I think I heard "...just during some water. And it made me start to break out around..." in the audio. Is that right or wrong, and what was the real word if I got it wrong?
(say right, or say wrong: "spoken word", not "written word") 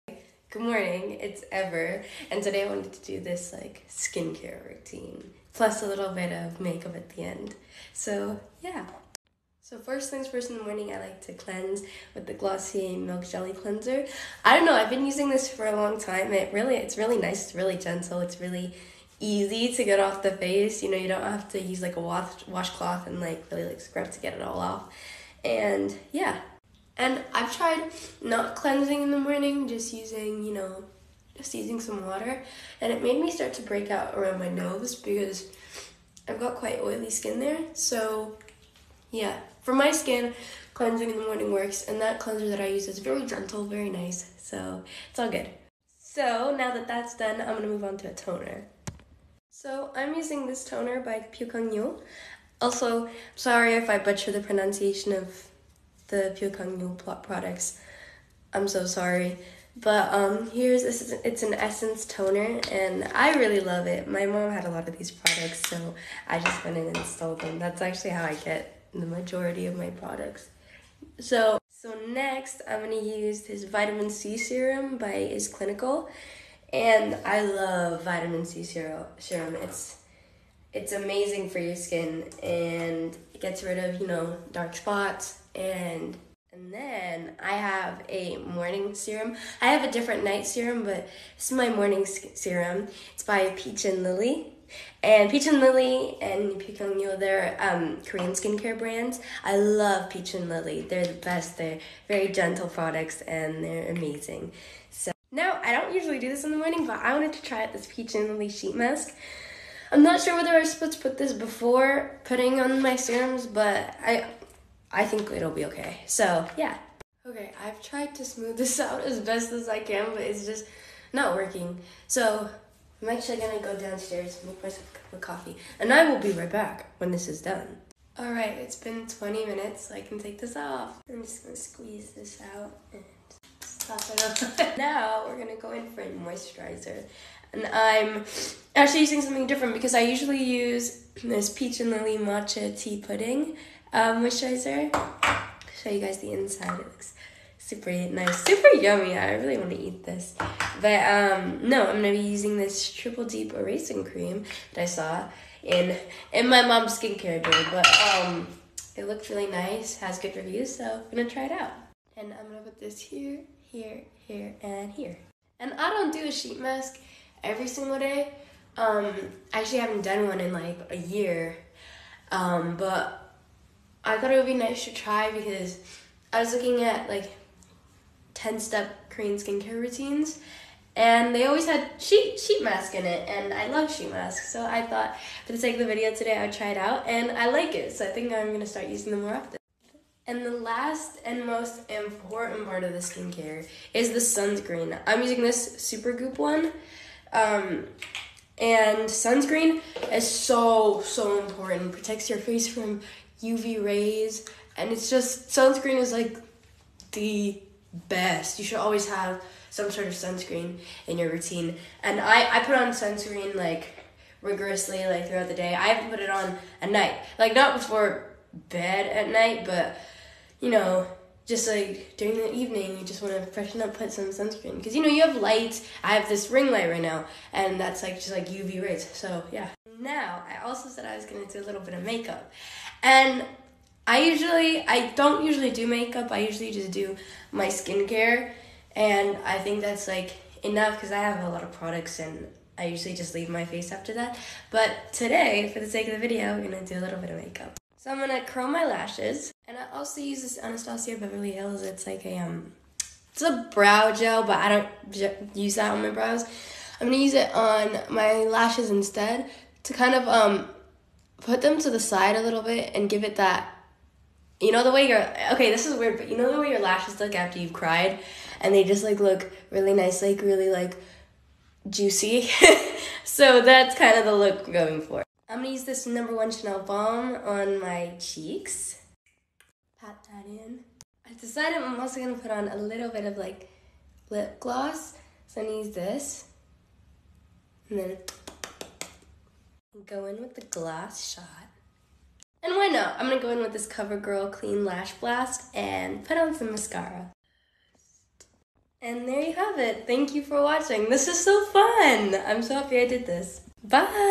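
wrong: "using", not "during".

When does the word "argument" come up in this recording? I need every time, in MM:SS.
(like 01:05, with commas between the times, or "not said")
not said.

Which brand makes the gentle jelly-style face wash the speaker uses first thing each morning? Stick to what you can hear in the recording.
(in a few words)
Glossier.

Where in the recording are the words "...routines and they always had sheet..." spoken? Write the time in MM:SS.
02:59.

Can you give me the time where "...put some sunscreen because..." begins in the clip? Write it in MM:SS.
03:43.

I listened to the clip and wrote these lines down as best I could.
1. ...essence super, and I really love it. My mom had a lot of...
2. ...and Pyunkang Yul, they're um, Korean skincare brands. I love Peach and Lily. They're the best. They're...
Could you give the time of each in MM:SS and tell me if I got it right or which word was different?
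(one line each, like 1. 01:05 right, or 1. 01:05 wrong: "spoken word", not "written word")
1. 01:01 wrong: "toner", not "super"
2. 01:36 right.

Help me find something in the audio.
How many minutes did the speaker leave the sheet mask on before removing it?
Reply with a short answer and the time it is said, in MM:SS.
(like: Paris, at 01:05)
20, at 02:09.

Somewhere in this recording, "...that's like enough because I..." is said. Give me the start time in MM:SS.
03:59.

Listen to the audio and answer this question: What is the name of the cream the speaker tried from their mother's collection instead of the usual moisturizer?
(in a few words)
Triple Deep Erasing Cream.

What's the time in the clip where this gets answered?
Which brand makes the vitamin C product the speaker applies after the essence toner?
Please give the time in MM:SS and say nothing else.
01:15.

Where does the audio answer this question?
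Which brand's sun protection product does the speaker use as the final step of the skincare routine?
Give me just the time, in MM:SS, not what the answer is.
03:15.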